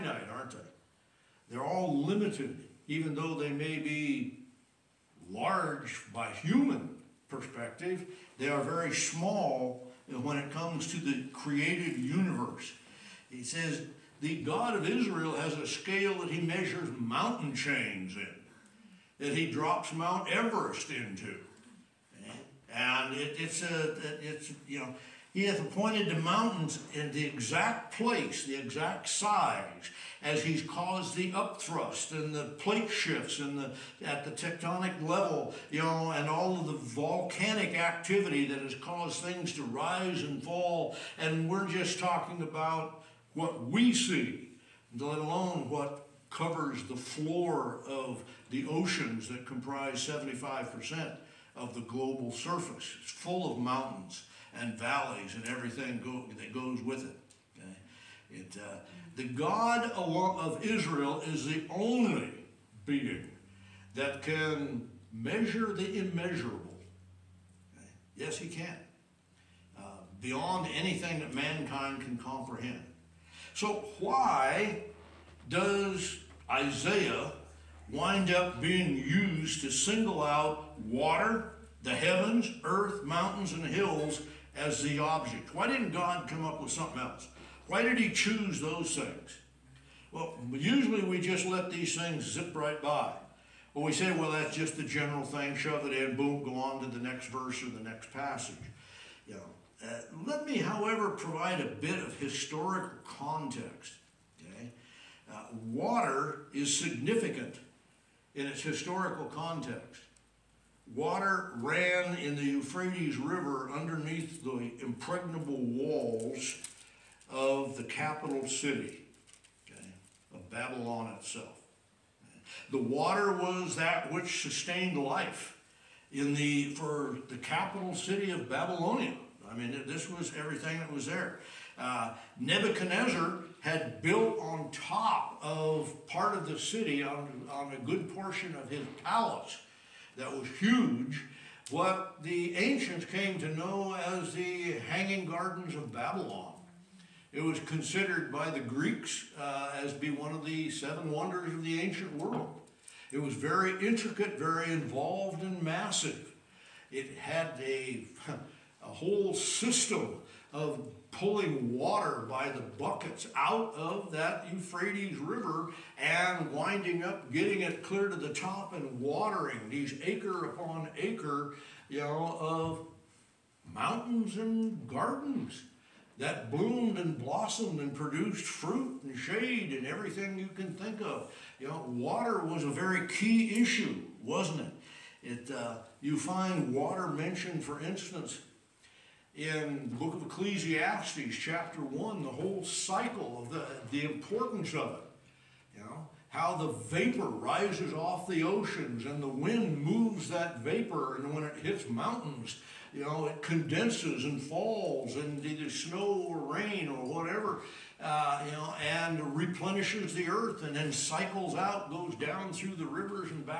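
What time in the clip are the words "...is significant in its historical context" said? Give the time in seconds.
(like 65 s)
106 s.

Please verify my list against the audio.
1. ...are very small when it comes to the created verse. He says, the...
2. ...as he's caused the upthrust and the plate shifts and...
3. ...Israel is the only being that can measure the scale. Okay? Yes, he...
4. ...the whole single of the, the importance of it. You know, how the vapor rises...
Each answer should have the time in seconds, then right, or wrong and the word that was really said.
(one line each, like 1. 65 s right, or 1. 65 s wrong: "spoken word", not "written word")
1. 8 s wrong: "universe", not "verse"
2. 30 s right
3. 60 s wrong: "immeasurable", not "scale"
4. 192 s wrong: "cycle", not "single".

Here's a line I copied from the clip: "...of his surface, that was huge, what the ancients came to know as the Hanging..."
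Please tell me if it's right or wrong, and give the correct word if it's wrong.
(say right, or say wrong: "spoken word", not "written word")
wrong: "palace", not "surface".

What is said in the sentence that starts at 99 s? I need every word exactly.
You know, uh, let me, however, provide a bit of historical context.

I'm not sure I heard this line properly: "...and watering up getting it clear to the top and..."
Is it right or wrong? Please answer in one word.
wrong.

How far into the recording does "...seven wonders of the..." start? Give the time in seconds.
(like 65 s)
150 s.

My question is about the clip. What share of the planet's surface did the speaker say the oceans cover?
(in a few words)
75%.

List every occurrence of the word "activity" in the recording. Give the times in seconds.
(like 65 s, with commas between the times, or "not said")
37 s.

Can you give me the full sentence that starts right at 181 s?
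You know, water was a very key issue, wasn't it?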